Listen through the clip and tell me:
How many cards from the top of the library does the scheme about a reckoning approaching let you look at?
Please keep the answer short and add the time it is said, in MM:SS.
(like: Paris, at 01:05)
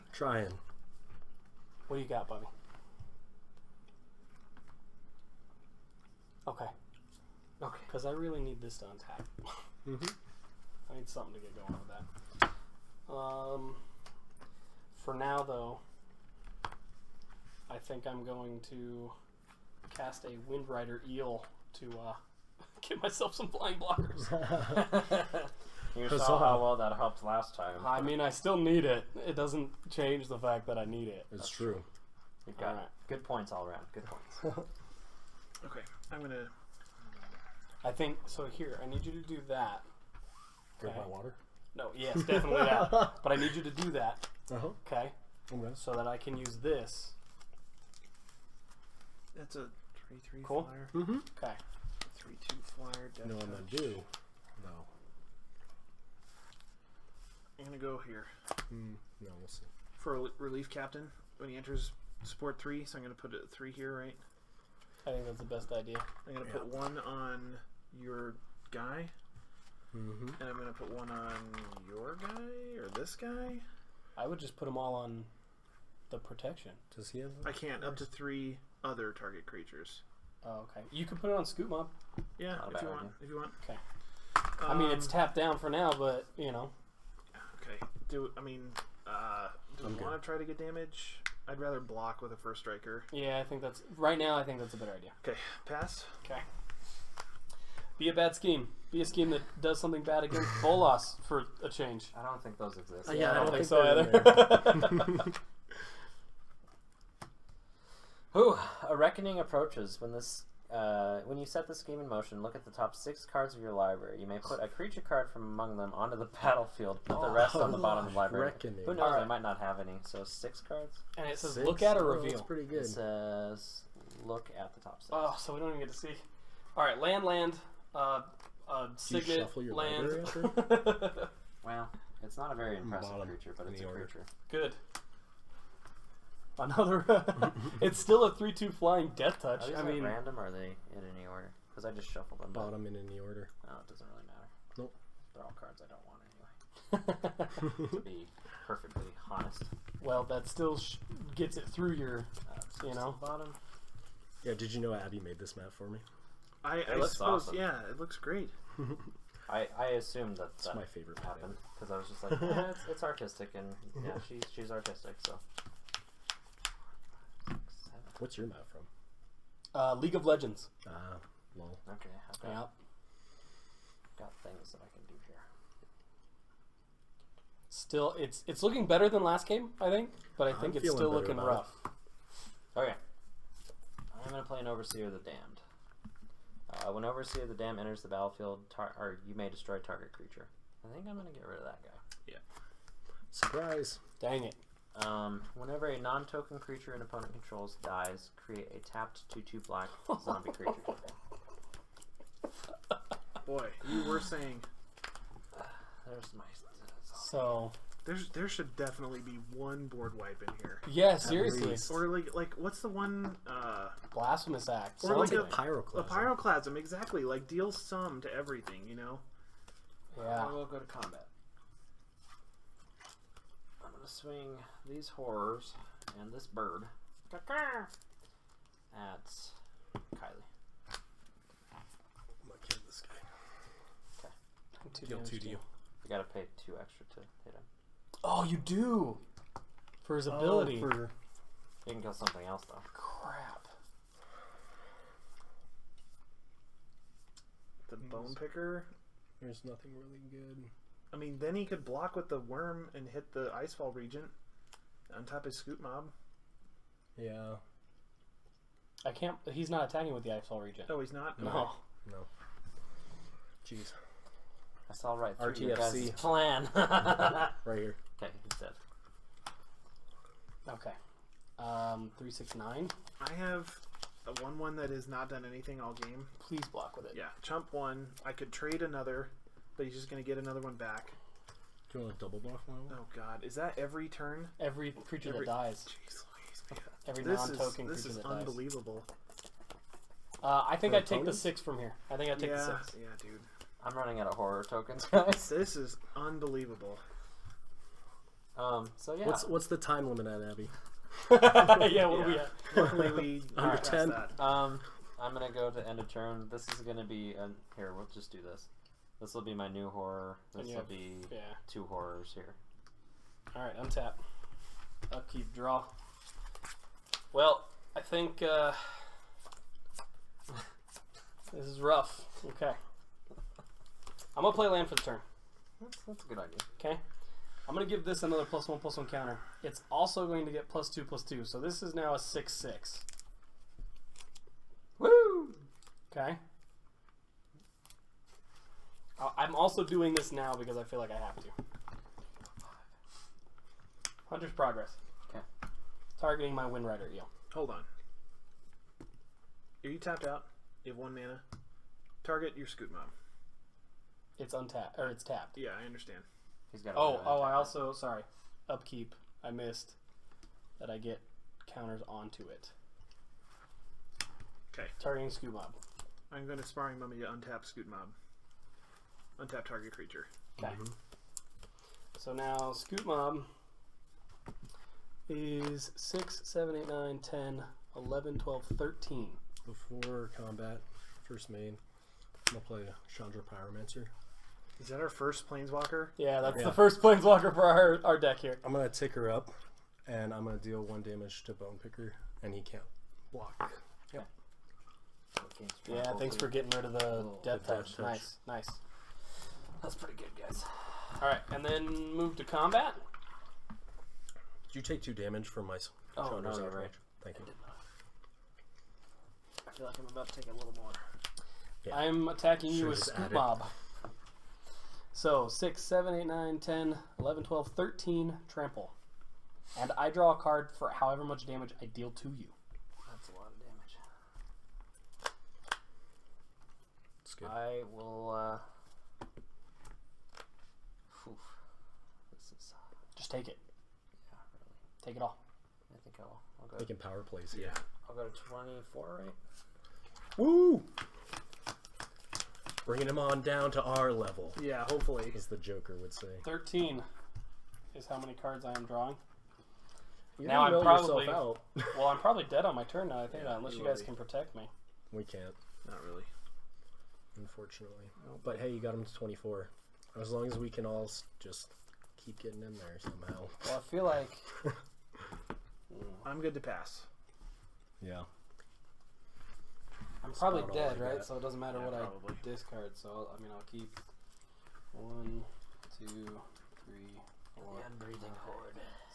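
6, at 01:52.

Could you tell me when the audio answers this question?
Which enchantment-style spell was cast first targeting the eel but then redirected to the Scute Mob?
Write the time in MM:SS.
05:44.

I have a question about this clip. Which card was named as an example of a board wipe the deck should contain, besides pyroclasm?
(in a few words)
Blasphemous Act.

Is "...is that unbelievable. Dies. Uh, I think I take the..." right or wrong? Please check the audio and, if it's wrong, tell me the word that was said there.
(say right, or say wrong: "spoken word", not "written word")
right.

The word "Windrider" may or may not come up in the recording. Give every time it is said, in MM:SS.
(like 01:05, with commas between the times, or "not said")
00:20, 05:46.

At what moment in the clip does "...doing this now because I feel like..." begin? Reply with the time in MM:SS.
05:39.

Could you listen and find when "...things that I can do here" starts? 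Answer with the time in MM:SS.
02:54.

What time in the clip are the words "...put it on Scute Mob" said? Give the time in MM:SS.
01:21.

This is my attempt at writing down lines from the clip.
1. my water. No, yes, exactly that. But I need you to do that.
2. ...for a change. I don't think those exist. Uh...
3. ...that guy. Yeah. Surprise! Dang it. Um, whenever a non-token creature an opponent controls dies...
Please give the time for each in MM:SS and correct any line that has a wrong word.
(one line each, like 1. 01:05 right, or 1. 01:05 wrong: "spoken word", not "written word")
1. 00:41 wrong: "definitely", not "exactly"
2. 01:41 right
3. 03:11 right.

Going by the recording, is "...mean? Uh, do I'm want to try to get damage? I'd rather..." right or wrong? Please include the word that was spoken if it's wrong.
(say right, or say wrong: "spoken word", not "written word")
right.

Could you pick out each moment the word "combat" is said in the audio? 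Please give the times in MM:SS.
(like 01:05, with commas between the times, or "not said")
03:40, 06:20, 06:42.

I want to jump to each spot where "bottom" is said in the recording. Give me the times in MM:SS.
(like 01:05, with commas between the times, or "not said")
01:57, 02:22, 02:33.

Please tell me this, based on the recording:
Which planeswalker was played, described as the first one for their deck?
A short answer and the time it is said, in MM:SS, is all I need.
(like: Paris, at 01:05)
Chandra Pyromaster, at 06:23.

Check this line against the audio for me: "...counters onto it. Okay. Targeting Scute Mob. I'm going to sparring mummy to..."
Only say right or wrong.
right.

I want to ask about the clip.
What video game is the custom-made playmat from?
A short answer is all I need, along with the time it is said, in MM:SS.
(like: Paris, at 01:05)
League of Legends, at 02:49.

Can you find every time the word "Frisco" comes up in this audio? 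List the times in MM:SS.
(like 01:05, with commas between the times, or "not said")
not said.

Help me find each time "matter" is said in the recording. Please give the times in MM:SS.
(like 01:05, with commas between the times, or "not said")
02:24, 07:51.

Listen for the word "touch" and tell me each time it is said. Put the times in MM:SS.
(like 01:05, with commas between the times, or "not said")
02:19, 06:37.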